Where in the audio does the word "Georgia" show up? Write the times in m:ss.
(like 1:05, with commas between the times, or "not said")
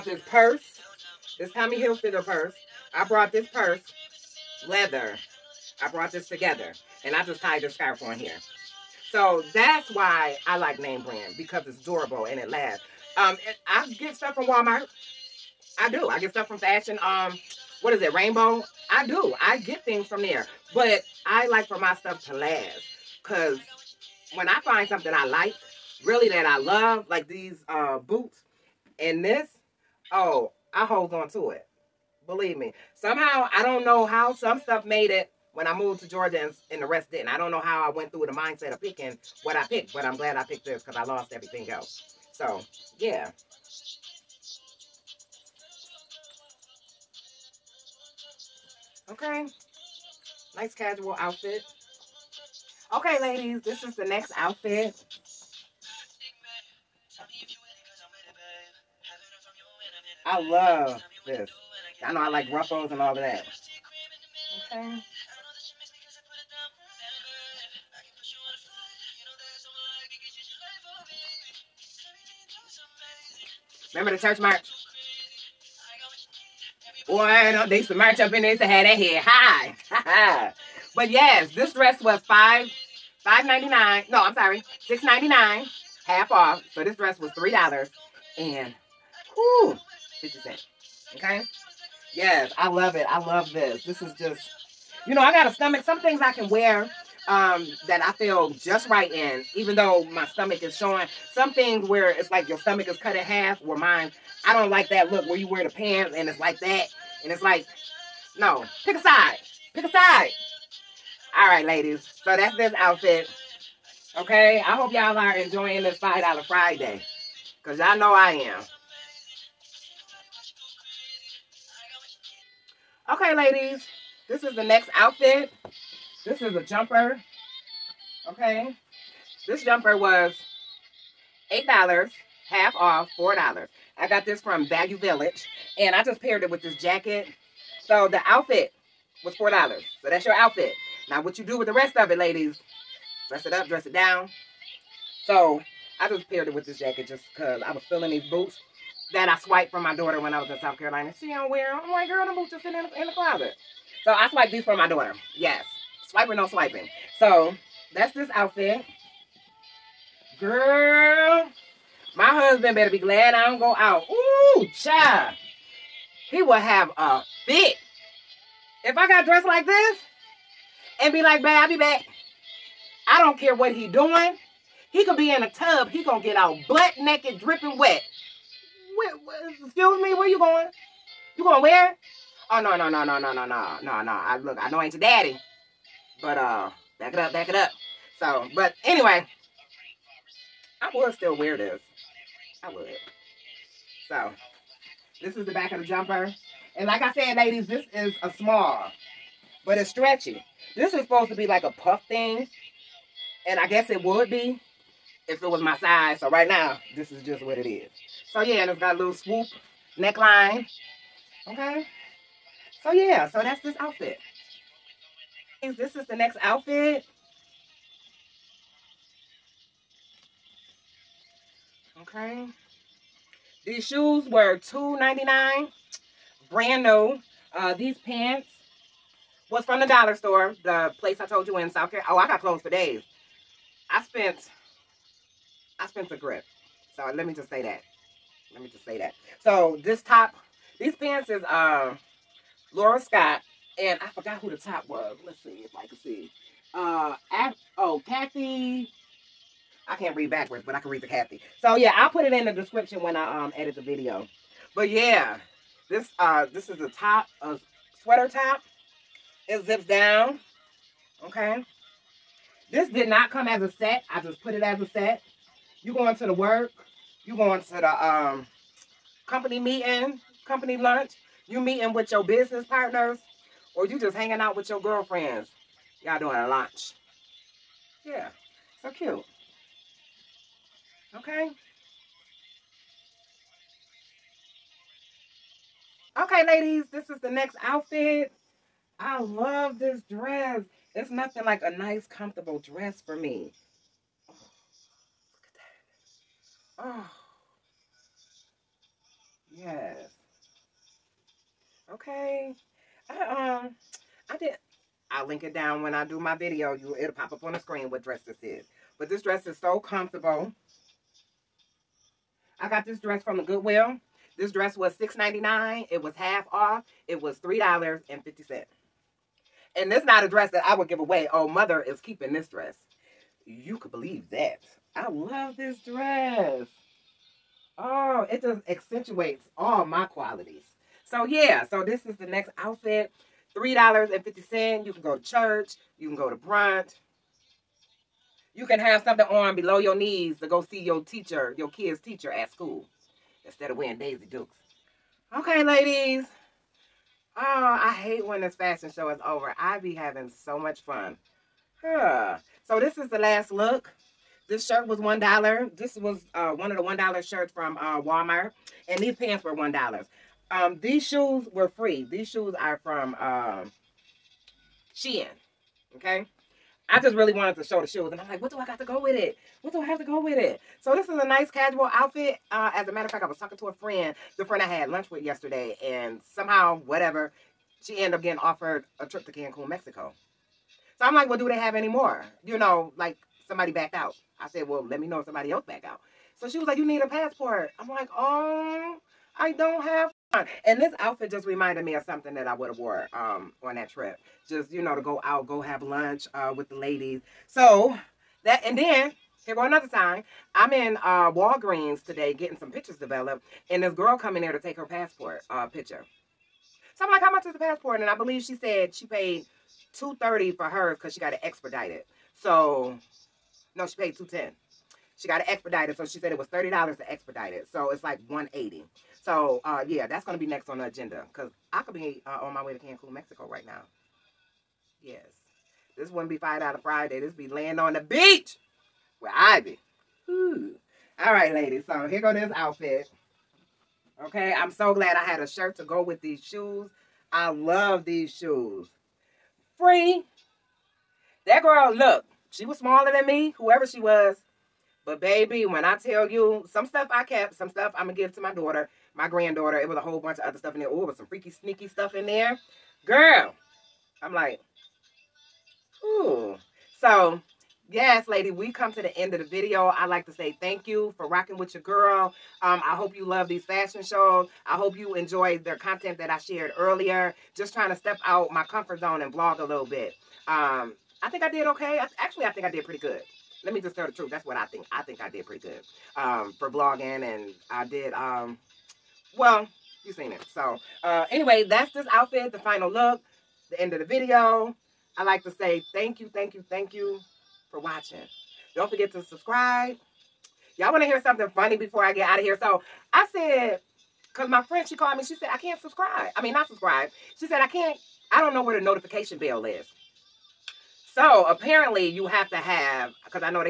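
0:36.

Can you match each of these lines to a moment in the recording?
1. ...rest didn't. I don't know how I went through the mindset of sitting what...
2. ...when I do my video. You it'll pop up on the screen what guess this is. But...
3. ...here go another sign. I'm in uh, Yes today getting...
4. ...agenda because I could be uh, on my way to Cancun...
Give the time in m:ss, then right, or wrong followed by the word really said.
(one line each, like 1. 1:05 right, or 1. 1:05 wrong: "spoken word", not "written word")
1. 0:36 wrong: "picking", not "sitting"
2. 5:05 wrong: "dress", not "guess"
3. 6:39 wrong: "Walgreens", not "Yes"
4. 7:00 right.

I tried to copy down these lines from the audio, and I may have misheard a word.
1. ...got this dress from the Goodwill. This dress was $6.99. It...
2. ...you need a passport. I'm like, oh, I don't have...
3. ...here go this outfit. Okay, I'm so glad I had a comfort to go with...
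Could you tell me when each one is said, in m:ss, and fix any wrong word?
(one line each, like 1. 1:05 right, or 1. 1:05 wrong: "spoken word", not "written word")
1. 5:12 right
2. 6:26 right
3. 7:12 wrong: "shirt", not "comfort".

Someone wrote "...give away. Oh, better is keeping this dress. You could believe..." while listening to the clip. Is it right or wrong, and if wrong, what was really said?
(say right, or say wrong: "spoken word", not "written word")
wrong: "mother", not "better".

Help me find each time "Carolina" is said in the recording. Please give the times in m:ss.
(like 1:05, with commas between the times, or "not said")
2:30, 3:51.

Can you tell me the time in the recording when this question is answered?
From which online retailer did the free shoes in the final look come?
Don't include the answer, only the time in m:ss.
6:04.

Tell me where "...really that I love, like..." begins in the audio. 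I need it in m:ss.
0:26.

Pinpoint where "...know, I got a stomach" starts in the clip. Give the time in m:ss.
1:35.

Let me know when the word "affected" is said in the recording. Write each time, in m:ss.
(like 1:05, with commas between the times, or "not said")
not said.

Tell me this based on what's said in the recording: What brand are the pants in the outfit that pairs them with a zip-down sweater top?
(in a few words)
Laura Scott.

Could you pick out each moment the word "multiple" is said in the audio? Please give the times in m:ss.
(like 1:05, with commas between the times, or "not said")
not said.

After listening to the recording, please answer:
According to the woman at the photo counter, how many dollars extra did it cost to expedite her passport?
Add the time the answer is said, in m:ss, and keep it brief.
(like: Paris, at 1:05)
30, at 6:56.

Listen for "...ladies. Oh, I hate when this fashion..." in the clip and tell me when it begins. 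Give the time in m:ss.
5:45.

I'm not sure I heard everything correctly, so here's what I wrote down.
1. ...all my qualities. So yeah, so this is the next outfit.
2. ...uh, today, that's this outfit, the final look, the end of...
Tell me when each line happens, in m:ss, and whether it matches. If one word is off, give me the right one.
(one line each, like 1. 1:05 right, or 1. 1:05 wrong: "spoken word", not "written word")
1. 5:29 right
2. 8:01 wrong: "anyway", not "today".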